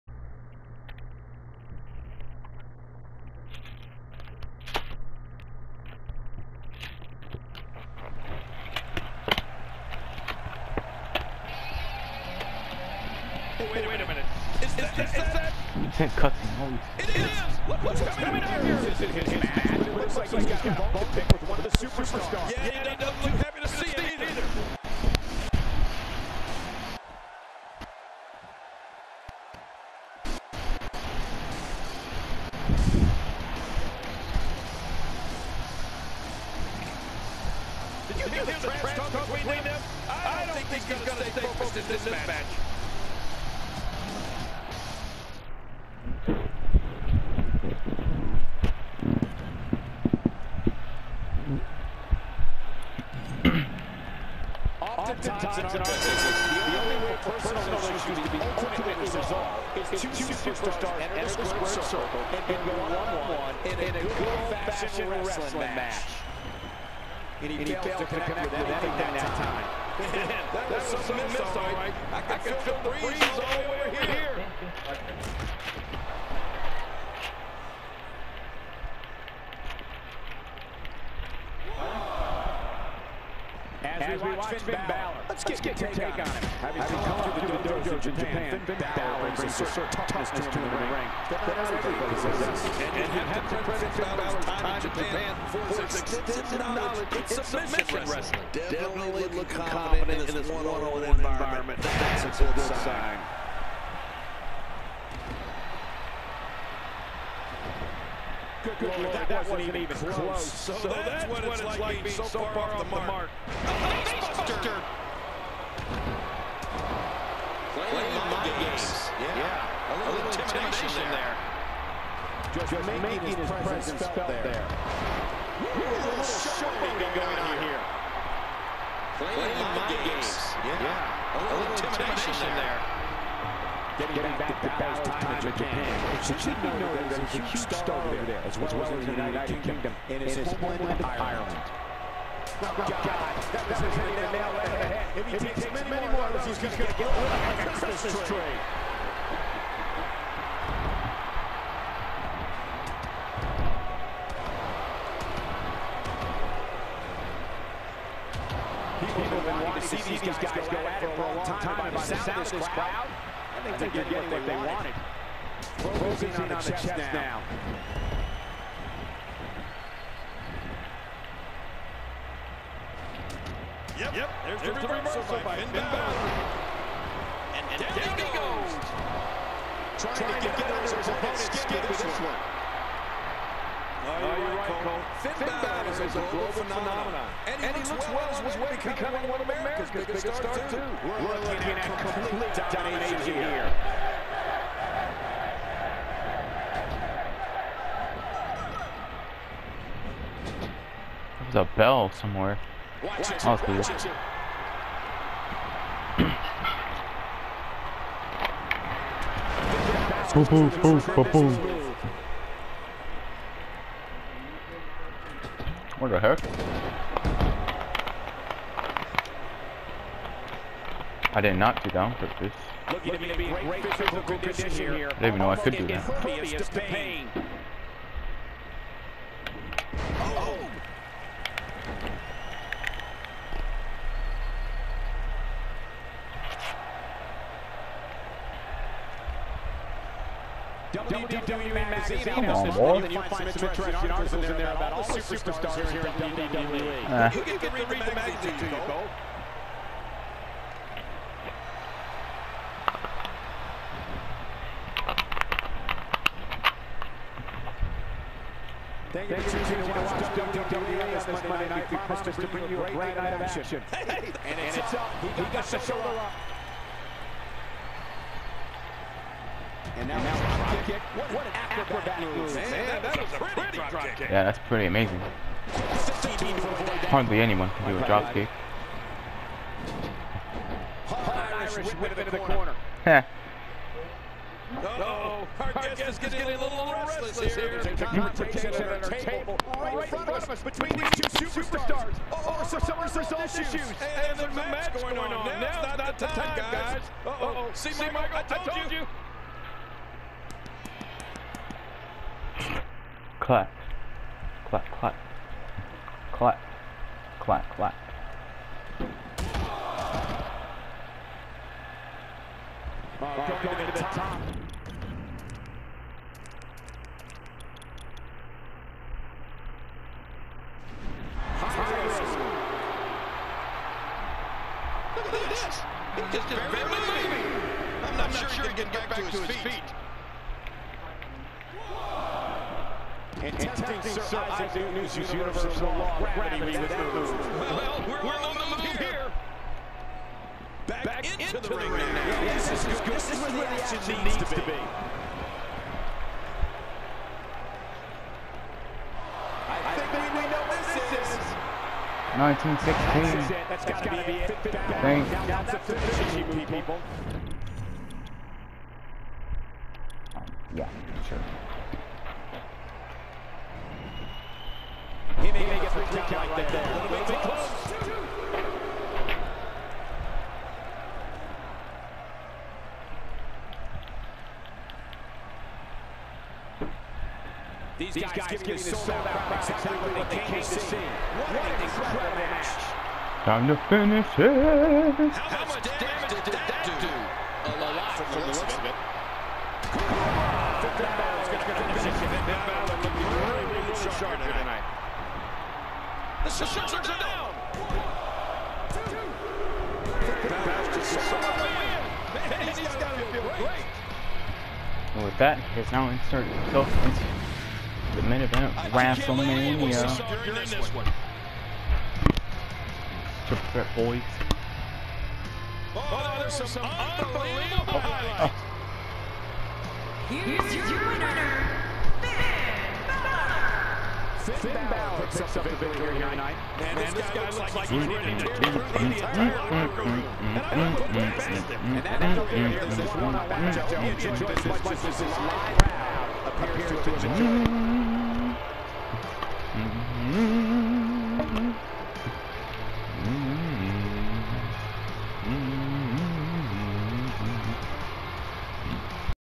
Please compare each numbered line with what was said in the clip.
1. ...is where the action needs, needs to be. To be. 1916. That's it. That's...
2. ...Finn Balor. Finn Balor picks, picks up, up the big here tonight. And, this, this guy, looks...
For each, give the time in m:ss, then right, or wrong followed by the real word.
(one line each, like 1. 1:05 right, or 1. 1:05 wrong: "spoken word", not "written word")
1. 5:43 right
2. 7:02 right.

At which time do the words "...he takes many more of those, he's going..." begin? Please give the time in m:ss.
2:25.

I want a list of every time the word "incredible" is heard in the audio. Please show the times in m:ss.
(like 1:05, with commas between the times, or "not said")
6:21.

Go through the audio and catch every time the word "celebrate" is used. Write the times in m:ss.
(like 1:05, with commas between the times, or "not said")
not said.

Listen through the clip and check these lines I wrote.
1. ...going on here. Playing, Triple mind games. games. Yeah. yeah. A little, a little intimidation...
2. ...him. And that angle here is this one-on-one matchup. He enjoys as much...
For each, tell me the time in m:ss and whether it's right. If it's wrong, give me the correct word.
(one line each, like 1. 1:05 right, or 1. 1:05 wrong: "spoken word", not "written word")
1. 2:07 wrong: "Playing", not "Triple"
2. 7:11 right.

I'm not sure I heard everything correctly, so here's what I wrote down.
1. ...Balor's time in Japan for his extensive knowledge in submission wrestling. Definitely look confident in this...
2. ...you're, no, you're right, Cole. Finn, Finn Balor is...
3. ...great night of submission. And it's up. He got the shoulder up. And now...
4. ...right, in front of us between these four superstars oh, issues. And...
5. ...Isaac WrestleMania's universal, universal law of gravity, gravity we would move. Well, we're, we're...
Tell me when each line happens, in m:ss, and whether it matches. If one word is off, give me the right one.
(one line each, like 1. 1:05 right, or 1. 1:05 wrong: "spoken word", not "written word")
1. 1:34 right
2. 3:04 right
3. 4:22 wrong: "action", not "submission"
4. 4:49 wrong: "two", not "four"
5. 5:34 wrong: "Newton", not "WrestleMania".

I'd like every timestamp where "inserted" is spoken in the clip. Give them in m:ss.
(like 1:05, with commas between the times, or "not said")
6:46.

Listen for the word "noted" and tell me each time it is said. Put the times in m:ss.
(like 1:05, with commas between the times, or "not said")
2:16.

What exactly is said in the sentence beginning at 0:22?
Yeah, yeah, he doesn't look happy to see it either.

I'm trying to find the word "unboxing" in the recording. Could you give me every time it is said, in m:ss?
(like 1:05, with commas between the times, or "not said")
not said.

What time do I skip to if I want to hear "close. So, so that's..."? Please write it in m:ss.
1:50.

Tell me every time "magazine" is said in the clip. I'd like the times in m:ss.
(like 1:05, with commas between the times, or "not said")
4:01, 4:08.